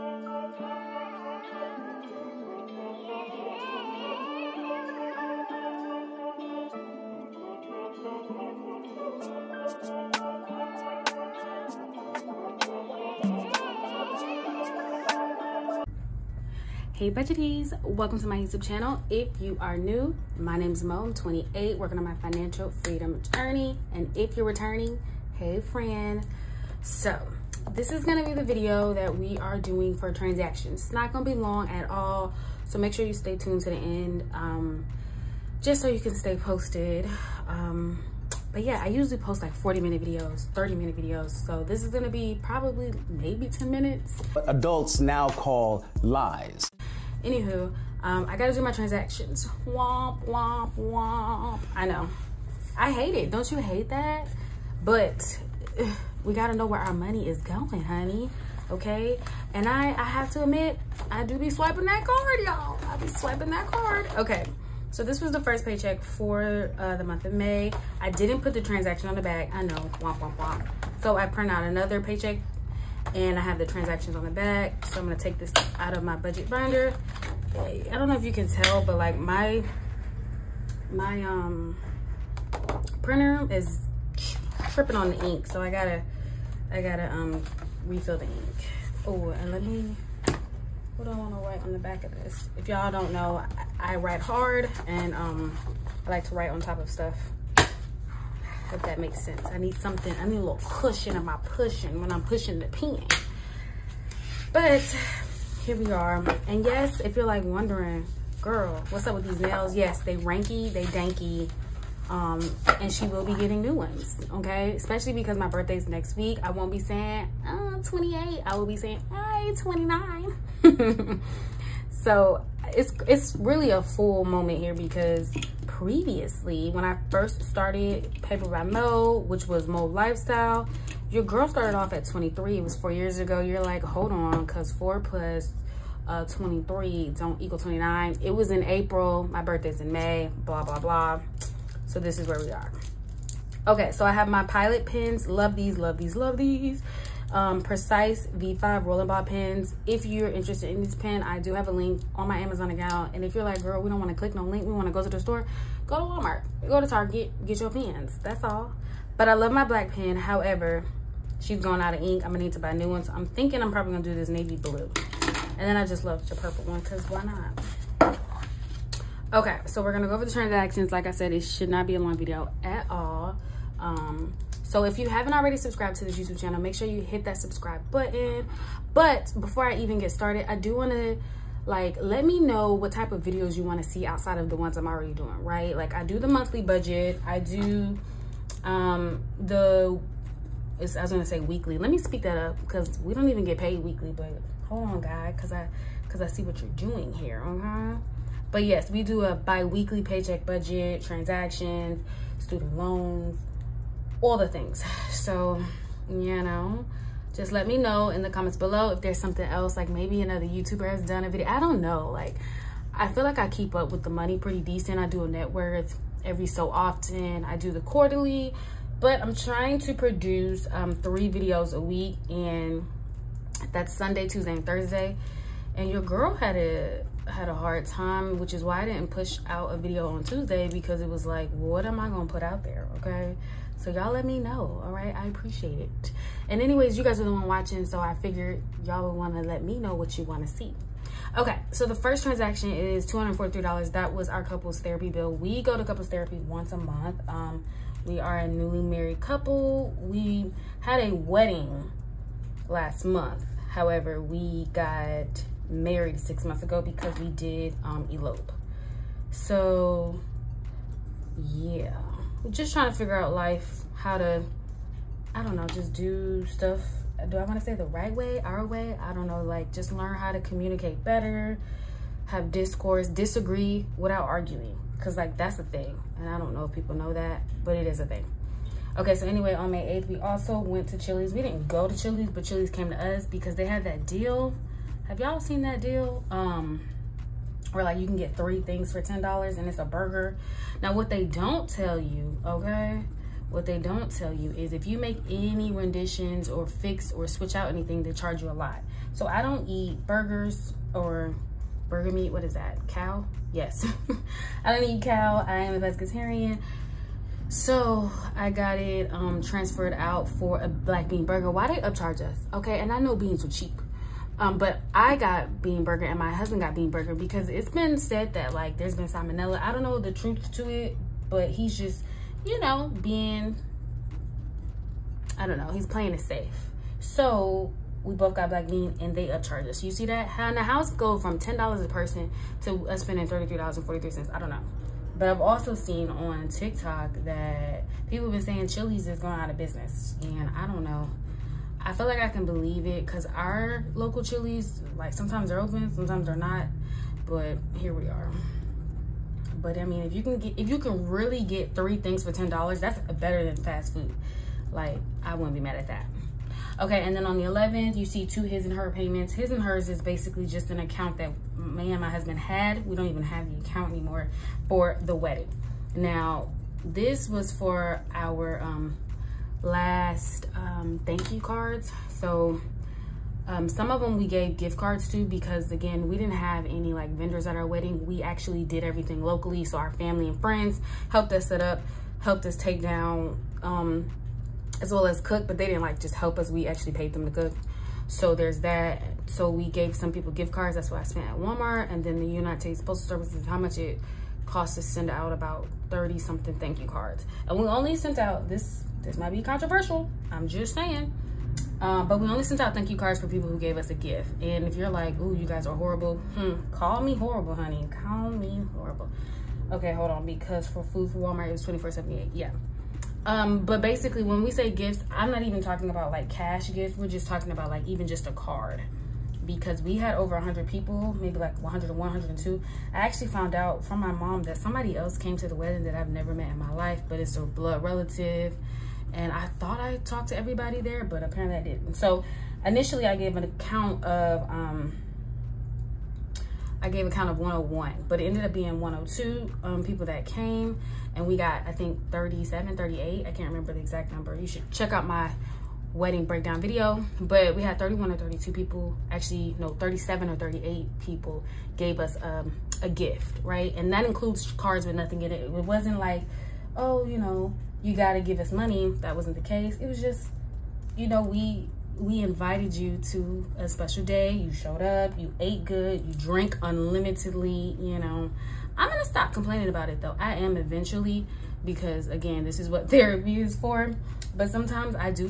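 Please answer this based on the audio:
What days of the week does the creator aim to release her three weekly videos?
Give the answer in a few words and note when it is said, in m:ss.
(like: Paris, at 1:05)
Sunday, Tuesday, and Thursday, at 3:43.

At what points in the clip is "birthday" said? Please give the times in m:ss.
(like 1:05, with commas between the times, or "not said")
1:55, 2:19.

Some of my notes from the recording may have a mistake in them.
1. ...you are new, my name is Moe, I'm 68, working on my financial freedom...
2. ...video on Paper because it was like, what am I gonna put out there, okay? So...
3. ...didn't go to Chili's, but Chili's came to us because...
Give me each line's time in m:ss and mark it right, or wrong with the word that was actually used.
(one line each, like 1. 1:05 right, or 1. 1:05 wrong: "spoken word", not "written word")
1. 0:19 wrong: "28", not "68"
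2. 3:49 wrong: "Tuesday", not "Paper"
3. 4:41 right.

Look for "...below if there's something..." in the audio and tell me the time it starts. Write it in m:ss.
3:28.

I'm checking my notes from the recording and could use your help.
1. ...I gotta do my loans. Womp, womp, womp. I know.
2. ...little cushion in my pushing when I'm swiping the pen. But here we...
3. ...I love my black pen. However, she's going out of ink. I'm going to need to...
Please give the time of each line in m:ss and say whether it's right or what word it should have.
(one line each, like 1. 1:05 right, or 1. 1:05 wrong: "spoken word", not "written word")
1. 0:48 wrong: "transactions", not "loans"
2. 1:40 wrong: "pushing", not "swiping"
3. 2:39 right.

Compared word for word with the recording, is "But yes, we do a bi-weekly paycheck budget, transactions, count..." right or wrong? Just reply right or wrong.
wrong.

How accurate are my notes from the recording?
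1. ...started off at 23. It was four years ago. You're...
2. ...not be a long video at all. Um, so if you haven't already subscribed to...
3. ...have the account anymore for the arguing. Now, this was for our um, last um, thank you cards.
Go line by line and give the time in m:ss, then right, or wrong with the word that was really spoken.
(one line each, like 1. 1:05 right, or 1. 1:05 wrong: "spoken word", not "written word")
1. 2:11 right
2. 2:51 right
3. 6:03 wrong: "wedding", not "arguing".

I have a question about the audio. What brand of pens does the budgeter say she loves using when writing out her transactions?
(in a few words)
Pilot.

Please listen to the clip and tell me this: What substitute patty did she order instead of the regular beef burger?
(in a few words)
black bean burger.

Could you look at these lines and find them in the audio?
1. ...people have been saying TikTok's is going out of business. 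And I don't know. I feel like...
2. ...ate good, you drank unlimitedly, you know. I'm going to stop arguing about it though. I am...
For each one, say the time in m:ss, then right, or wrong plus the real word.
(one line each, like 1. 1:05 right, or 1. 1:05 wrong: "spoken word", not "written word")
1. 5:38 wrong: "Chili", not "TikTok"
2. 7:45 wrong: "complaining", not "arguing".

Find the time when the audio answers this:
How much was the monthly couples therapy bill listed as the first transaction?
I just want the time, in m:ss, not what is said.
4:03.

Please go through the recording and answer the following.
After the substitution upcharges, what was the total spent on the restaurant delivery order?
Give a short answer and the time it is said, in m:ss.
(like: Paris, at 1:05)
$33.43, at 5:33.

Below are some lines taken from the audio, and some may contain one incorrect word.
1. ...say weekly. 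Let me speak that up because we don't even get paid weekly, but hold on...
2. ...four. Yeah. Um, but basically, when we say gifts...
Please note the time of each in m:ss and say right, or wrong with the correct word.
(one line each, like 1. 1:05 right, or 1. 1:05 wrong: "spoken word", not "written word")
1. 3:11 right
2. 6:52 wrong: "eight", not "four".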